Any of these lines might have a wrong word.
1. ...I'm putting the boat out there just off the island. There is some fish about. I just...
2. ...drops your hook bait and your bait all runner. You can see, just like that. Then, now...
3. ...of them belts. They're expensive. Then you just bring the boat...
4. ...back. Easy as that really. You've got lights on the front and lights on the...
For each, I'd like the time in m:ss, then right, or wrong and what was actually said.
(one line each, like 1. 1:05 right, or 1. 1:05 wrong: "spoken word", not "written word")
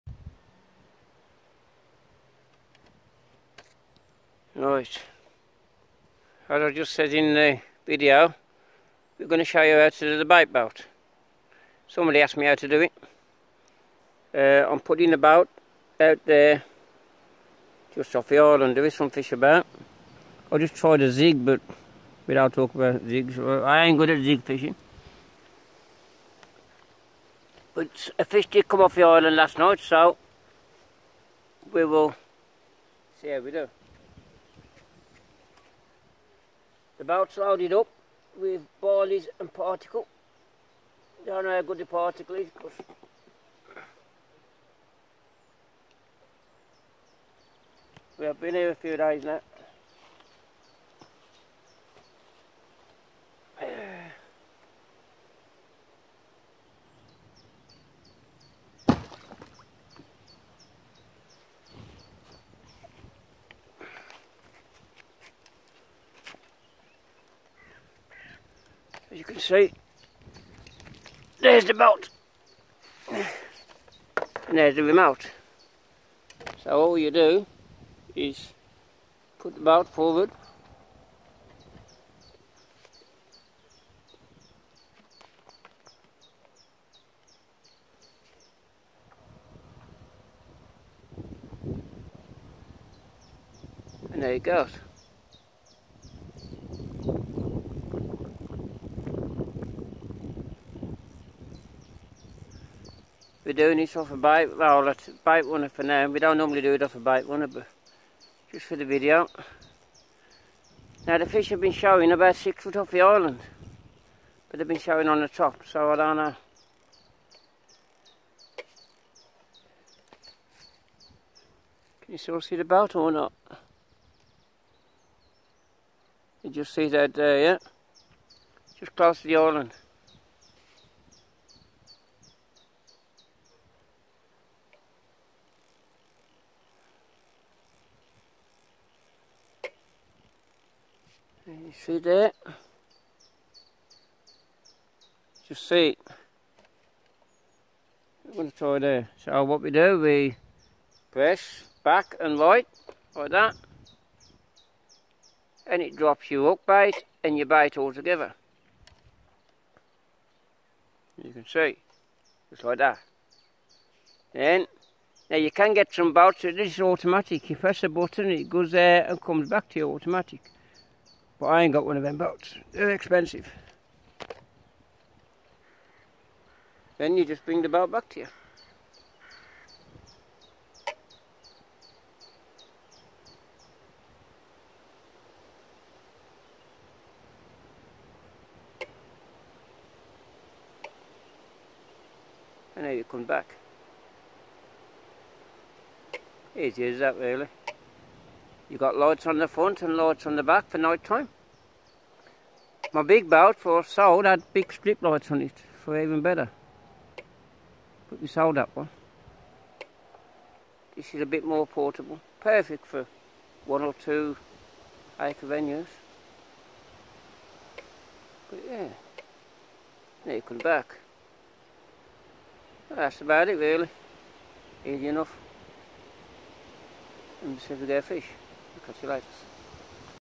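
1. 0:14 right
2. 2:35 wrong: "together", not "runner"
3. 2:51 wrong: "boats", not "belts"
4. 3:13 right.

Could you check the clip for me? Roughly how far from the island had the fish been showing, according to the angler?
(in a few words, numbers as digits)
6 feet.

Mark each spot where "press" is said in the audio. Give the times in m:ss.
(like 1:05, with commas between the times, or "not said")
2:31, 2:47.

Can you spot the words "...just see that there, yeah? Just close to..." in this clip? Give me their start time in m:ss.
2:06.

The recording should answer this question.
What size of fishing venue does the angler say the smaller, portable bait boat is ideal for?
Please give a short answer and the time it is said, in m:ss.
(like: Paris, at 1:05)
1 or 2 acres, at 3:33.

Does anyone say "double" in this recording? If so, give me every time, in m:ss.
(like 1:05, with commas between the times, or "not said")
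not said.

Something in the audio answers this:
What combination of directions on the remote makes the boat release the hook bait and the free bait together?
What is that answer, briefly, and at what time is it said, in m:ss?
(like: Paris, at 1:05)
Back and right, at 2:31.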